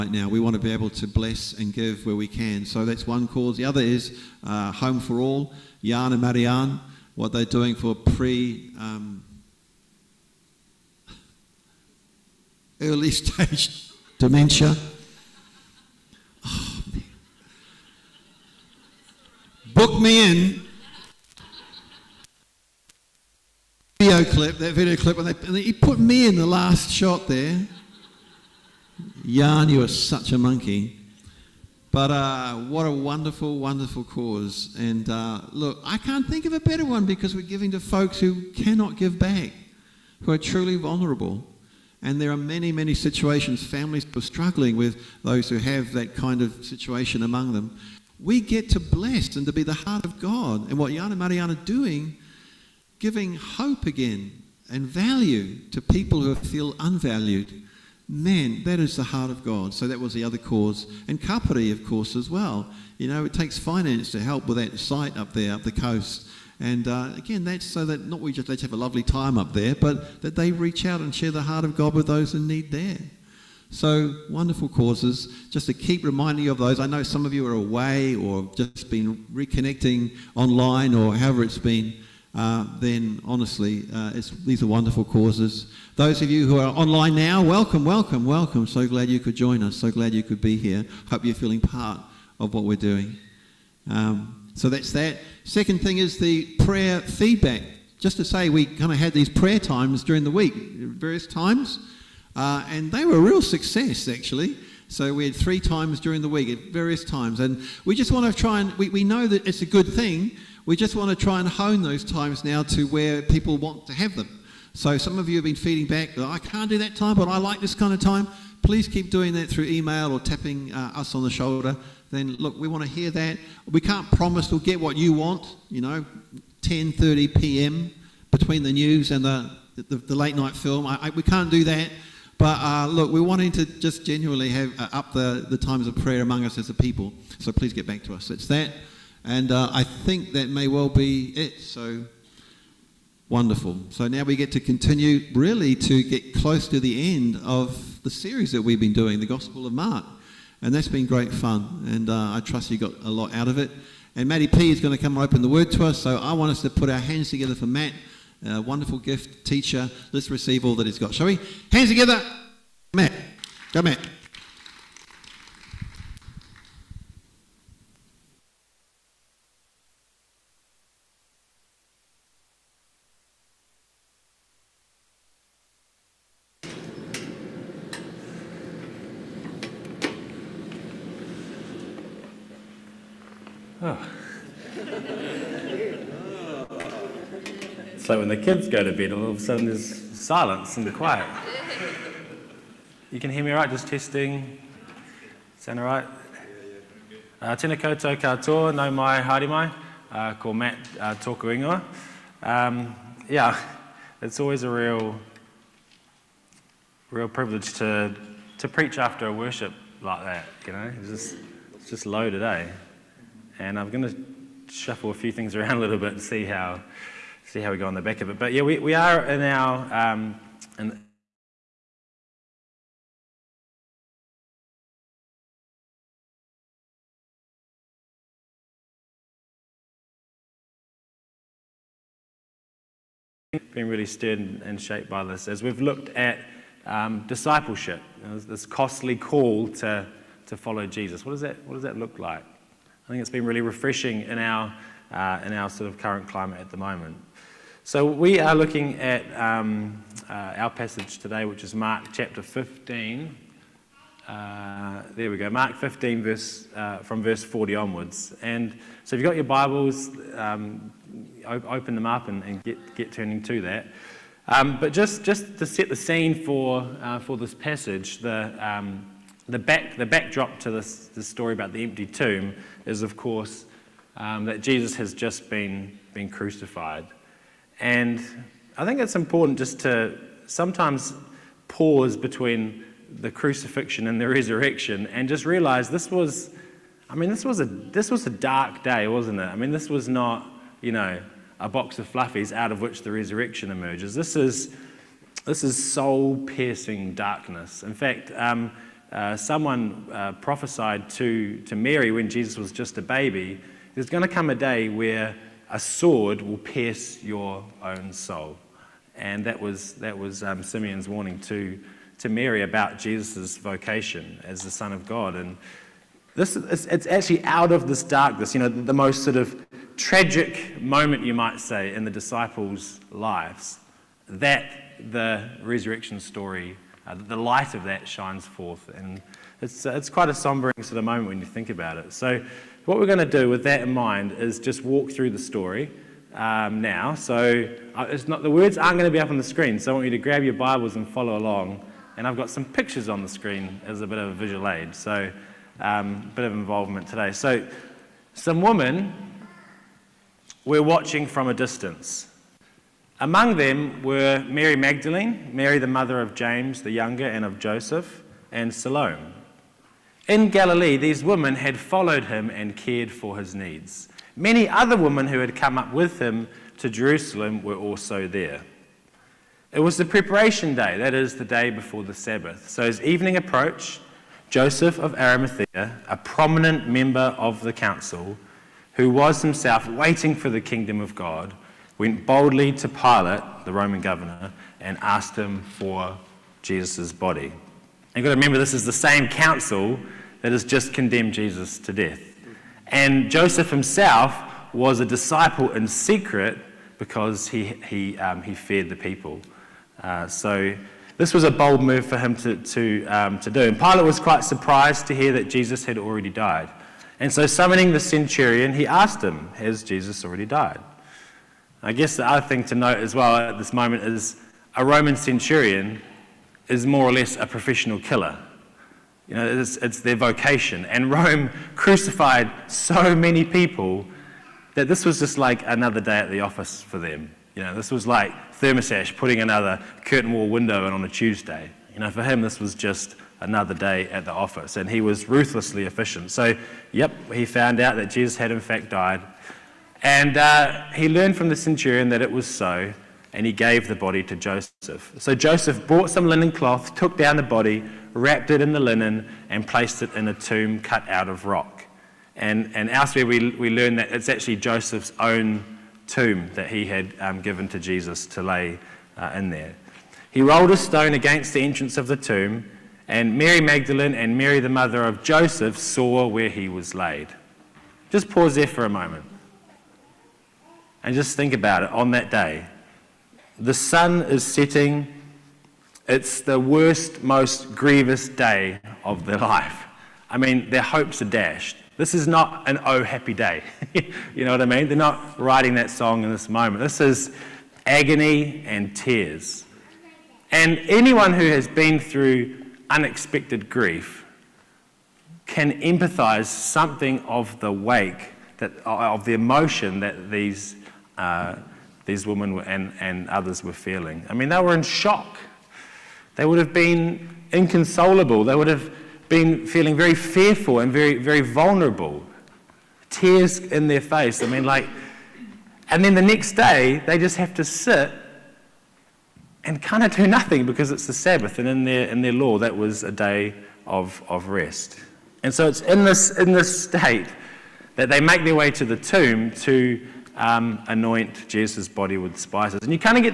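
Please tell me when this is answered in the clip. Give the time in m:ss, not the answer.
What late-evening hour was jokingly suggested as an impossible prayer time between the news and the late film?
2:06.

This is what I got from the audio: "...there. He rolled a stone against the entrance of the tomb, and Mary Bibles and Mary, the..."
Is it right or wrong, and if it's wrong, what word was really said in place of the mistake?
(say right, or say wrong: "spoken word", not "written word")
wrong: "Magdalene", not "Bibles".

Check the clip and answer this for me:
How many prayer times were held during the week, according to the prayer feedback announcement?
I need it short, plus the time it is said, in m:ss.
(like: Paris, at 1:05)
3, at 1:45.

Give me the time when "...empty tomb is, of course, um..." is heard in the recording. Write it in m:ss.
4:31.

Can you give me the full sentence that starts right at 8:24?
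I mean, they were in shock.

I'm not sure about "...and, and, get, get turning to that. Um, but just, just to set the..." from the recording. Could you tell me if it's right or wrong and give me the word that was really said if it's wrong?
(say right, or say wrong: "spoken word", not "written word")
right.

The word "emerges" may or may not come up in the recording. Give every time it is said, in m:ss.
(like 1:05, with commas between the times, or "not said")
4:53.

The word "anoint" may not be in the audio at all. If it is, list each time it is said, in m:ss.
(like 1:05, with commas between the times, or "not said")
8:50.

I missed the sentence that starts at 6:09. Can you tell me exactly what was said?
It was the preparation day, that is, the day before the Sabbath.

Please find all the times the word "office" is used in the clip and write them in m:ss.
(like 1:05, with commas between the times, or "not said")
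7:06, 7:14.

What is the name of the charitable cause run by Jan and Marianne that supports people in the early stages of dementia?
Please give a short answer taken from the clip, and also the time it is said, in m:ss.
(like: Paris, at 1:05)
Home for All, at 0:04.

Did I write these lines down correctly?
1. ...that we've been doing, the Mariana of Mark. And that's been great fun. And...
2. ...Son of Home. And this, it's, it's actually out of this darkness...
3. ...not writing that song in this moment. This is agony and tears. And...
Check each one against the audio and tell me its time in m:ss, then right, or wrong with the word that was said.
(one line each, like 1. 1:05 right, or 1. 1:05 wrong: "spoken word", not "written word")
1. 2:28 wrong: "Gospel", not "Mariana"
2. 5:14 wrong: "God", not "Home"
3. 8:04 right.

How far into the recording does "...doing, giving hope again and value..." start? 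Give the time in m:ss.
0:51.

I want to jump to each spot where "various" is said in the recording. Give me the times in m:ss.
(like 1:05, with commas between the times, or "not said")
1:40, 1:46.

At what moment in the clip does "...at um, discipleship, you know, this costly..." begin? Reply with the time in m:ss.
3:56.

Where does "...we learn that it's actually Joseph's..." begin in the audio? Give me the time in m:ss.
7:33.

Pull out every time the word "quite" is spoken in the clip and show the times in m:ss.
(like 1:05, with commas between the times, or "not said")
5:30, 6:44.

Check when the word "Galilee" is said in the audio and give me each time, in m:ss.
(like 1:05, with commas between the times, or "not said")
6:00.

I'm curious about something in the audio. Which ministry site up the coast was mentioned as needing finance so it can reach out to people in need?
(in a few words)
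Kapari.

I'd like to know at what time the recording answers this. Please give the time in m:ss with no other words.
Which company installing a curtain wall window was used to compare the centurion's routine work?
7:08.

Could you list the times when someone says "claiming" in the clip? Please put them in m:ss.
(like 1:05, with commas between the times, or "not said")
not said.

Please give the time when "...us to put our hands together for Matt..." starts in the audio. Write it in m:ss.
2:36.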